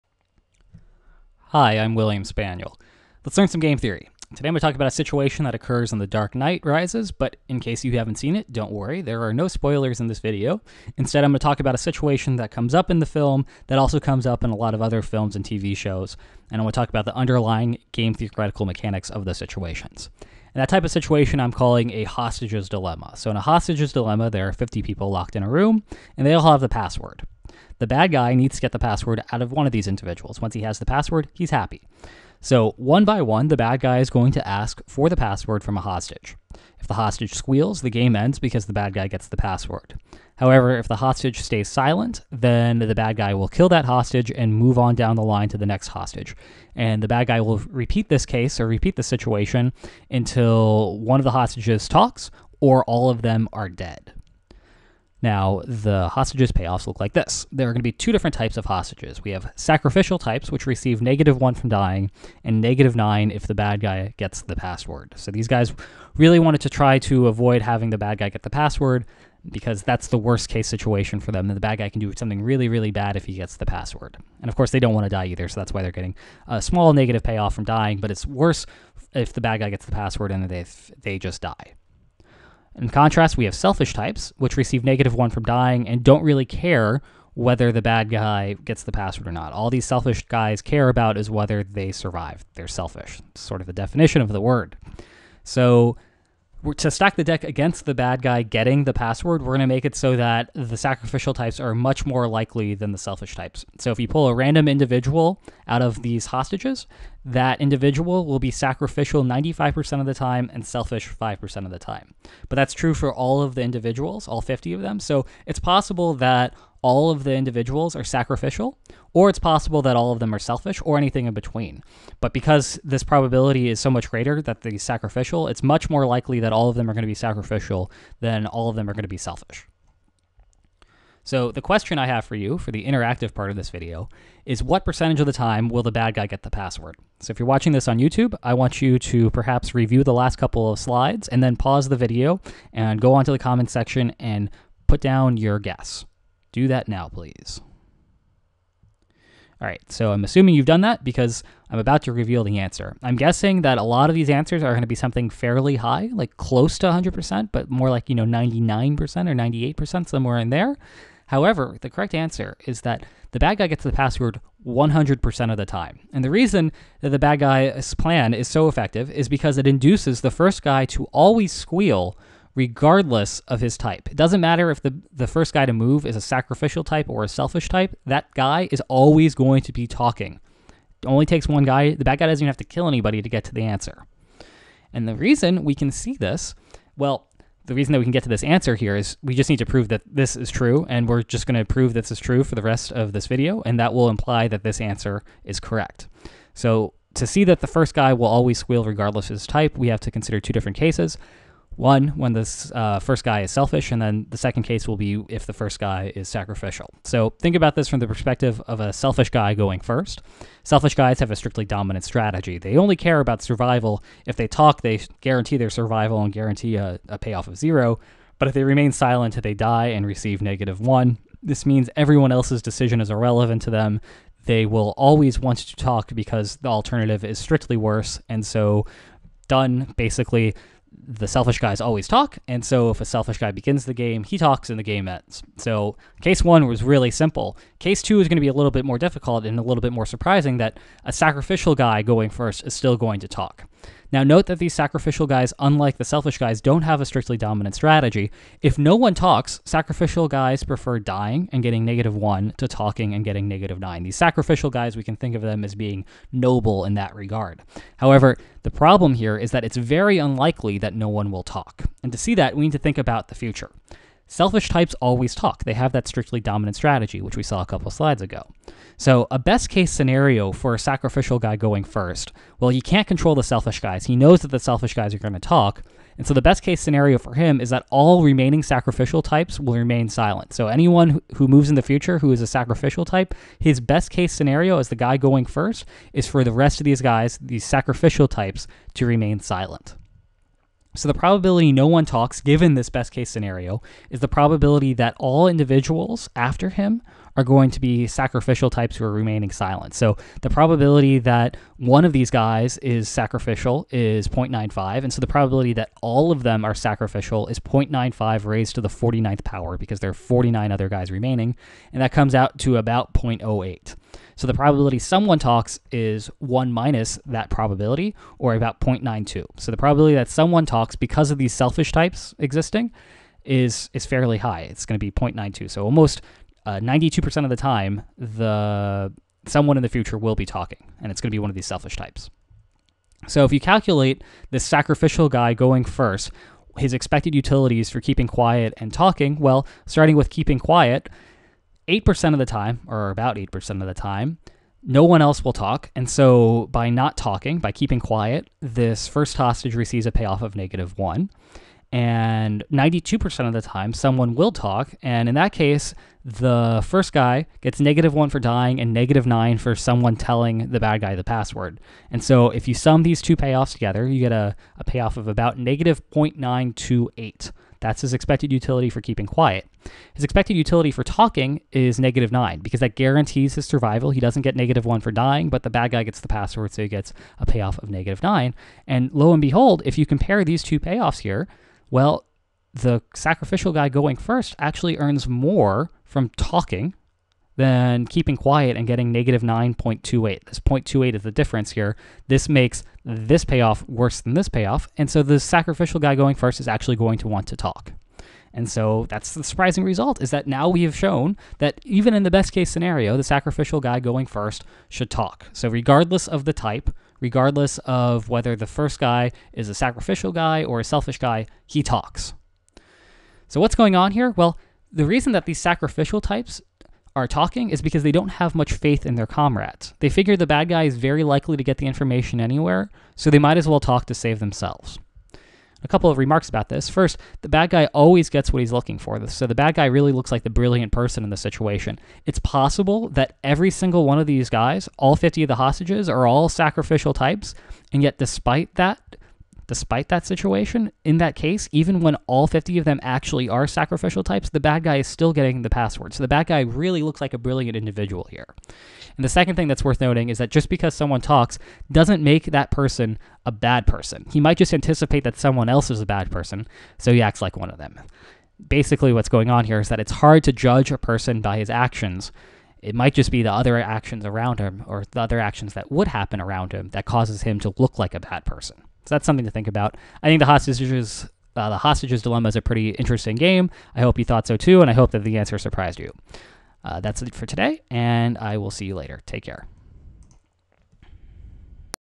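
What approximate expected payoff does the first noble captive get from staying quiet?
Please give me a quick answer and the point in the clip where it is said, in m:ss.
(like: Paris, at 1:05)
-9.28, at 6:05.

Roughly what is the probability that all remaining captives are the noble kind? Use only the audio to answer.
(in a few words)
0.08.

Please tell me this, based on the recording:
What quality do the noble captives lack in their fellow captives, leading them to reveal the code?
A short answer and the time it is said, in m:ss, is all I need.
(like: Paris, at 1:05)
faith, at 6:58.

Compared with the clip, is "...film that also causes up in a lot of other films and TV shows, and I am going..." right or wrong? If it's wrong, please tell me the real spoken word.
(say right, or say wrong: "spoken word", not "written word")
wrong: "comes", not "causes".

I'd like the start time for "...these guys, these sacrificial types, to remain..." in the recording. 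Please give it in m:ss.
4:46.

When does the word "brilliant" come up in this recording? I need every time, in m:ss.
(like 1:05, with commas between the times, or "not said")
7:10, 7:27.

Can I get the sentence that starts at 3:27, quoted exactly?
So think about this from the perspective of a selfish guy going first.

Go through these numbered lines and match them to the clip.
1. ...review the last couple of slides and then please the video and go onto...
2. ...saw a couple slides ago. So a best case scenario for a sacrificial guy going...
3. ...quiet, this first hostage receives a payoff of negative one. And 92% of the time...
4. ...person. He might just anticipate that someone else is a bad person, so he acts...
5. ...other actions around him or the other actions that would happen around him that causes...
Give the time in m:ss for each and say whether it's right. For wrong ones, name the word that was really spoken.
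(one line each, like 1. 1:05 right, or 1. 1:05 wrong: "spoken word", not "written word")
1. 2:19 wrong: "pause", not "please"
2. 4:27 right
3. 5:47 right
4. 7:33 right
5. 7:43 right.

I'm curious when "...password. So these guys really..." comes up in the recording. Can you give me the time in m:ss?
1:04.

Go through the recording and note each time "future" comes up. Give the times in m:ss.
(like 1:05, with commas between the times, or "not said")
4:23, 4:41, 5:29.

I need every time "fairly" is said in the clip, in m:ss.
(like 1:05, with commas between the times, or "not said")
2:35, 5:24.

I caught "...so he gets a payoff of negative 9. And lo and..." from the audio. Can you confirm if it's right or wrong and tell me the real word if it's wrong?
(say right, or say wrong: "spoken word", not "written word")
right.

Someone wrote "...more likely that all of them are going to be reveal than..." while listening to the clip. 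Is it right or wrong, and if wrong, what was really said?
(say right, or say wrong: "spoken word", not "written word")
wrong: "sacrificial", not "reveal".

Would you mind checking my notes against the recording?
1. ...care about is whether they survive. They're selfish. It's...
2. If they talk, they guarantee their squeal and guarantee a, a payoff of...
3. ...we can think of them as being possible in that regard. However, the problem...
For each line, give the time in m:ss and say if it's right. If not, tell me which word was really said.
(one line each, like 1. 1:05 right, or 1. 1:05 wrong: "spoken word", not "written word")
1. 1:30 right
2. 3:34 wrong: "survival", not "squeal"
3. 4:14 wrong: "noble", not "possible".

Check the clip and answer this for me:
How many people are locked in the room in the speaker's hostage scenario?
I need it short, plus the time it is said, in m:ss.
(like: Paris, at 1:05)
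50, at 0:24.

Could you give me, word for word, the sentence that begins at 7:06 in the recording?
First, the bad guy always gets what he's looking for.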